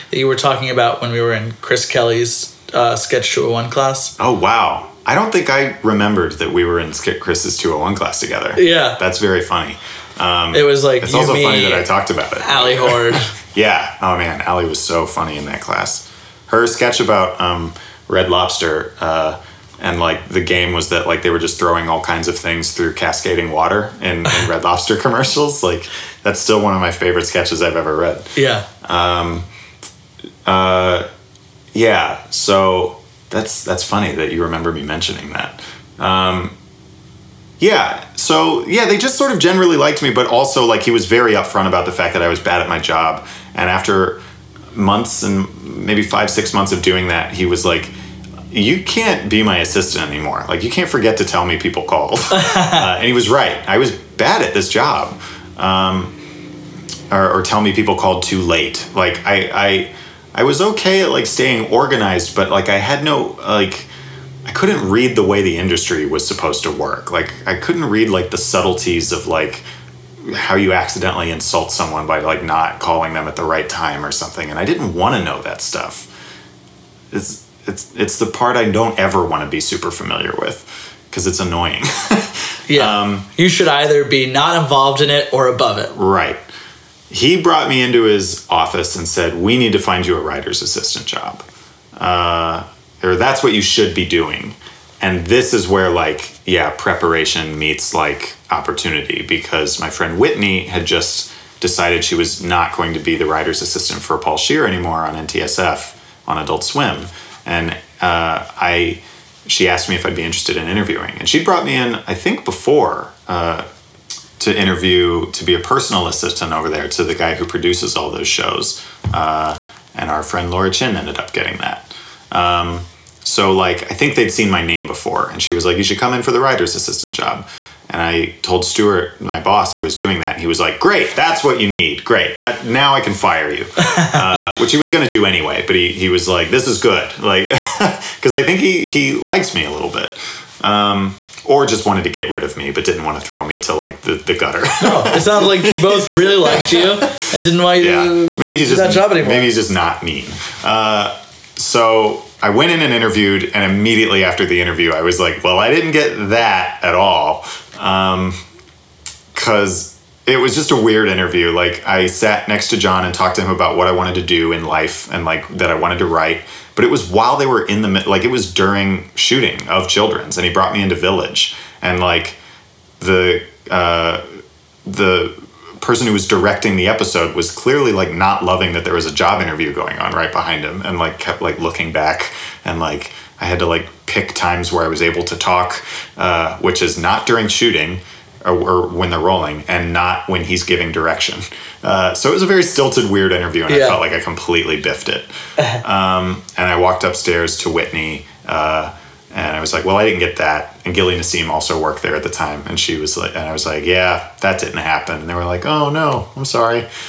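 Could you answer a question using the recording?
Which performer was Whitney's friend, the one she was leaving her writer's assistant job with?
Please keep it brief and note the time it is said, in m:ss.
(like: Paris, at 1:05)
Paul Scheer, at 1:44.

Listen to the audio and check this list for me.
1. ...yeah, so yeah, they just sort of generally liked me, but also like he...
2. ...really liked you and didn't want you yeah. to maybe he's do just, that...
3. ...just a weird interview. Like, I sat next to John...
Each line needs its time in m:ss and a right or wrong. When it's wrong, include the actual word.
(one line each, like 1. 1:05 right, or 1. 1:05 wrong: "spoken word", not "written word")
1. 0:37 right
2. 2:26 right
3. 2:40 right.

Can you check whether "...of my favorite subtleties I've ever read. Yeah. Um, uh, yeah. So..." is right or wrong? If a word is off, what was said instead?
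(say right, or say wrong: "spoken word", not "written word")
wrong: "sketches", not "subtleties".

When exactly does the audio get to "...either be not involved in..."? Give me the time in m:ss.
1:23.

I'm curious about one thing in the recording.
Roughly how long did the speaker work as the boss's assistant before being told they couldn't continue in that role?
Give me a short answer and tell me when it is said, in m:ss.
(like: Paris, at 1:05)
5-6 months, at 0:46.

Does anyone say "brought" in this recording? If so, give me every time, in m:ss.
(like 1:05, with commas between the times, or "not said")
1:27, 1:51, 2:50.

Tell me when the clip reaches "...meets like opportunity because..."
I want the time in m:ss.
1:37.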